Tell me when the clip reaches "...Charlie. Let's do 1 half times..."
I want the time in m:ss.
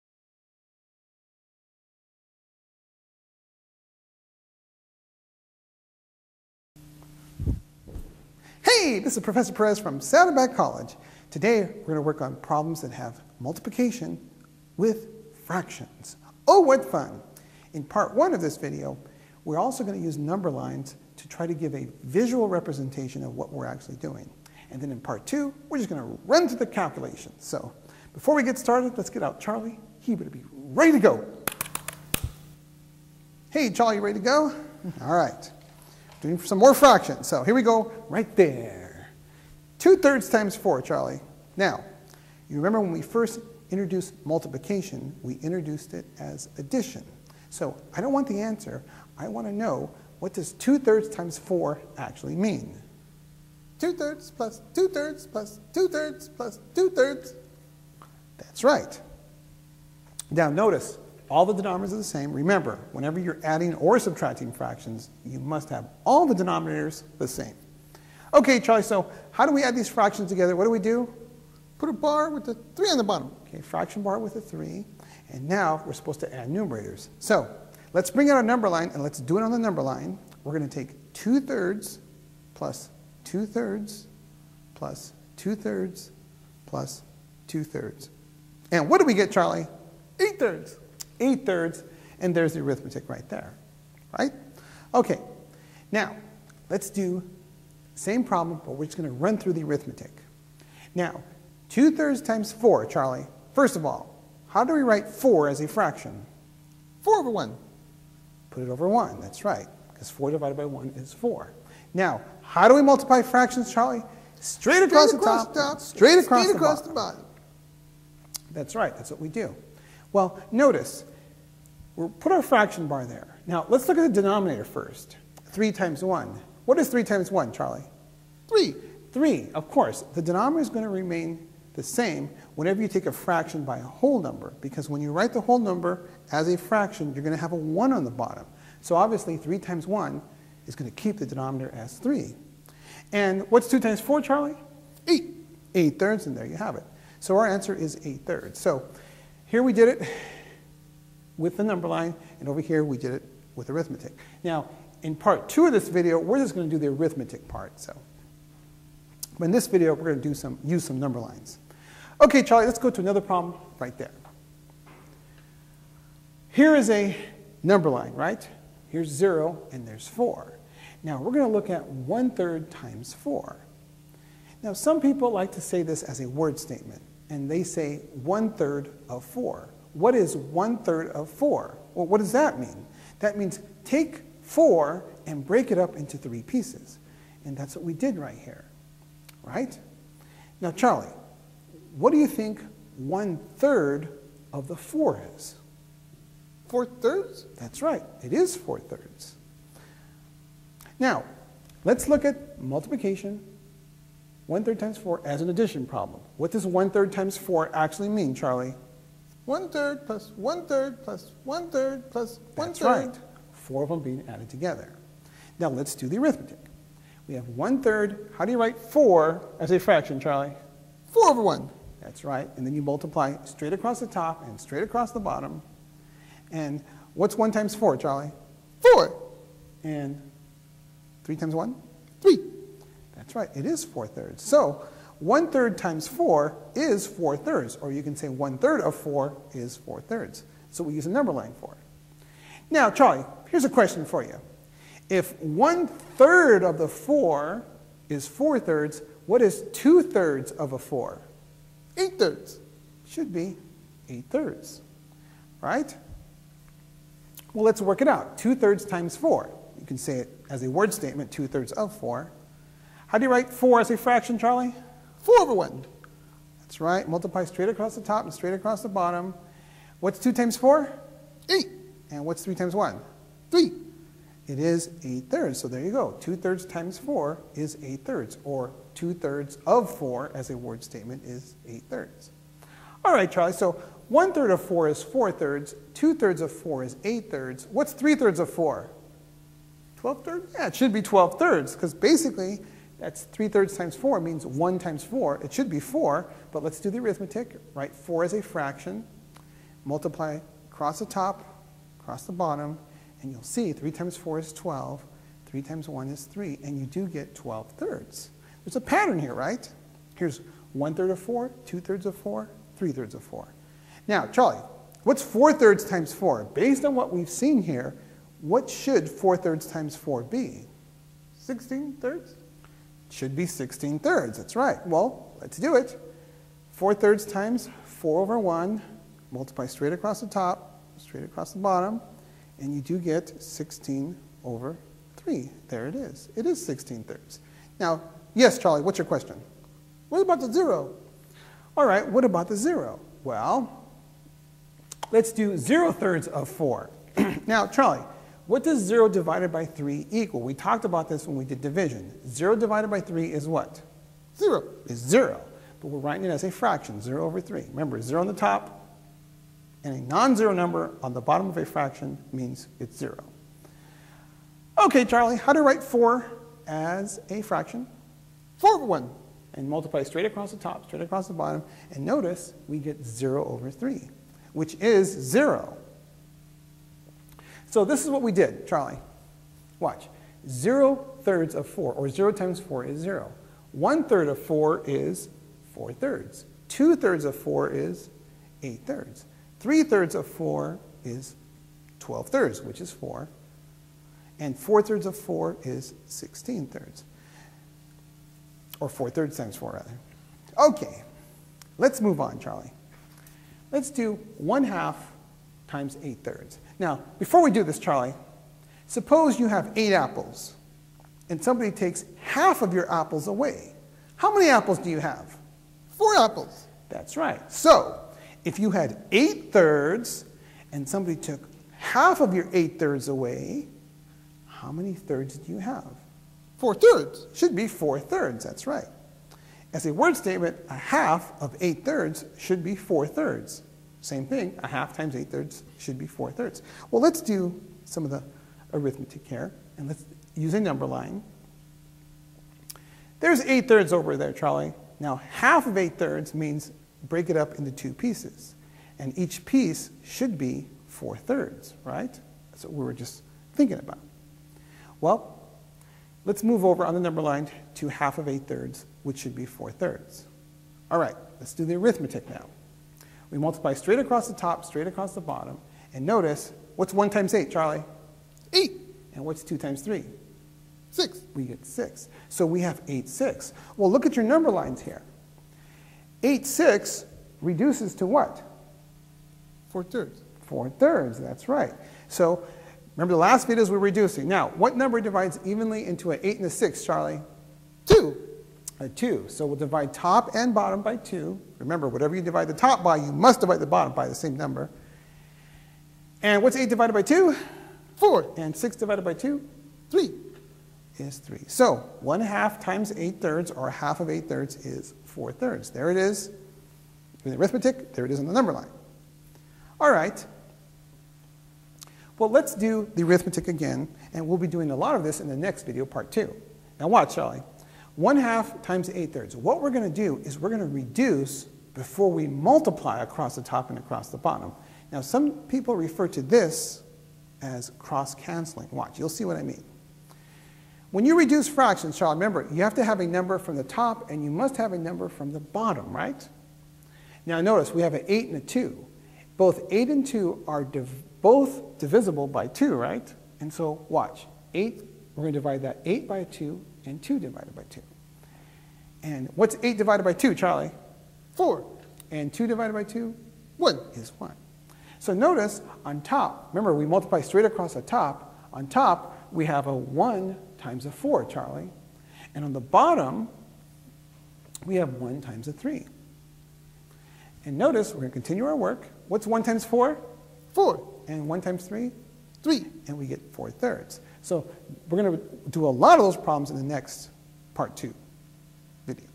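6:42.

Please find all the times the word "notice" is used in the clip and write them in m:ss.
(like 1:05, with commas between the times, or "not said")
1:00, 2:00, 6:12, 7:46, 8:57, 9:15, 9:27.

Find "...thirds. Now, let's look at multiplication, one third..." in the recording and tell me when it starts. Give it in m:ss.
3:18.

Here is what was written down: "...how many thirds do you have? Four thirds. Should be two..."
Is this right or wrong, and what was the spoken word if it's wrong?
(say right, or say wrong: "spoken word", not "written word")
wrong: "four", not "two".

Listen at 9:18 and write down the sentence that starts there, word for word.
On top, we have a 1 times a 4, Charlie.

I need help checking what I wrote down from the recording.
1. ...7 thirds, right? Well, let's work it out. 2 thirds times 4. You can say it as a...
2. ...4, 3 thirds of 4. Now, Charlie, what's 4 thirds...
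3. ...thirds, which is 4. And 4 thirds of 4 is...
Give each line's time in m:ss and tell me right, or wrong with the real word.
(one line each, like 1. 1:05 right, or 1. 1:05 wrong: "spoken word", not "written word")
1. 4:14 wrong: "8", not "7"
2. 5:12 right
3. 6:32 right.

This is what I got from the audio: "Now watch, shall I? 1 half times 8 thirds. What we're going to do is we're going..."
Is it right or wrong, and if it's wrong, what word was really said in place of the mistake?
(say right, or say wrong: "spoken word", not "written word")
right.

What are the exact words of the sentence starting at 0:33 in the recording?
Hey, Charlie, you ready to go?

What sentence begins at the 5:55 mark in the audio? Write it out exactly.
But we're writing it as a fraction, 0 over 3.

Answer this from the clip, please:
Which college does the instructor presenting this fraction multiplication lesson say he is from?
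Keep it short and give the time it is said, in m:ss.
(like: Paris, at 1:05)
Saddleback College, at 0:09.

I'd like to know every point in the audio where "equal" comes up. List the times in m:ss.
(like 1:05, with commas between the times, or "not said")
5:50.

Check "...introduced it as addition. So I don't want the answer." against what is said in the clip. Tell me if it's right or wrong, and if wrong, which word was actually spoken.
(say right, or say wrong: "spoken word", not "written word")
right.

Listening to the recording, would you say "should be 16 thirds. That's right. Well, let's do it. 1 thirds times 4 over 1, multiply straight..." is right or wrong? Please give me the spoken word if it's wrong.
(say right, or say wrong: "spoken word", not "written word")
wrong: "4", not "1".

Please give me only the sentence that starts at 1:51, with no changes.
Now, how do we multiply fractions, Charlie?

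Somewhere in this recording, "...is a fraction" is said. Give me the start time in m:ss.
4:58.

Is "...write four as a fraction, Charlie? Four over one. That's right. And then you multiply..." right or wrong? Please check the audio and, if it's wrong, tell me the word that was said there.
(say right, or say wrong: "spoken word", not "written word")
right.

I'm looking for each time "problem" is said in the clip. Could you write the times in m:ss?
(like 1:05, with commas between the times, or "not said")
0:12, 1:38, 2:43, 3:25, 9:36.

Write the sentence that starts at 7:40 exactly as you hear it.
All right, let's do the arithmetic now.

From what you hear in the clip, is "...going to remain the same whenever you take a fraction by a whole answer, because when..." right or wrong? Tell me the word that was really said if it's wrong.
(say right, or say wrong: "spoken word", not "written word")
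wrong: "number", not "answer".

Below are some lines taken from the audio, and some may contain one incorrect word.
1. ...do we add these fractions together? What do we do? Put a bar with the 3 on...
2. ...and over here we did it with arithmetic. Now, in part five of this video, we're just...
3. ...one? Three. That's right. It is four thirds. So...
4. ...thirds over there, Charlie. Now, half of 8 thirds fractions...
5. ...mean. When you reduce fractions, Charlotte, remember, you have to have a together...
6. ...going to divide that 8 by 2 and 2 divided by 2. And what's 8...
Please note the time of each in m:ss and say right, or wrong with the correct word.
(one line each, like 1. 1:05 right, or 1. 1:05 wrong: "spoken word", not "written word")
1. 1:09 right
2. 2:32 wrong: "two", not "five"
3. 3:51 right
4. 7:23 wrong: "means", not "fractions"
5. 8:49 wrong: "number", not "together"
6. 9:05 right.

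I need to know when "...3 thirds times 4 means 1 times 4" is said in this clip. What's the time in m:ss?
4:53.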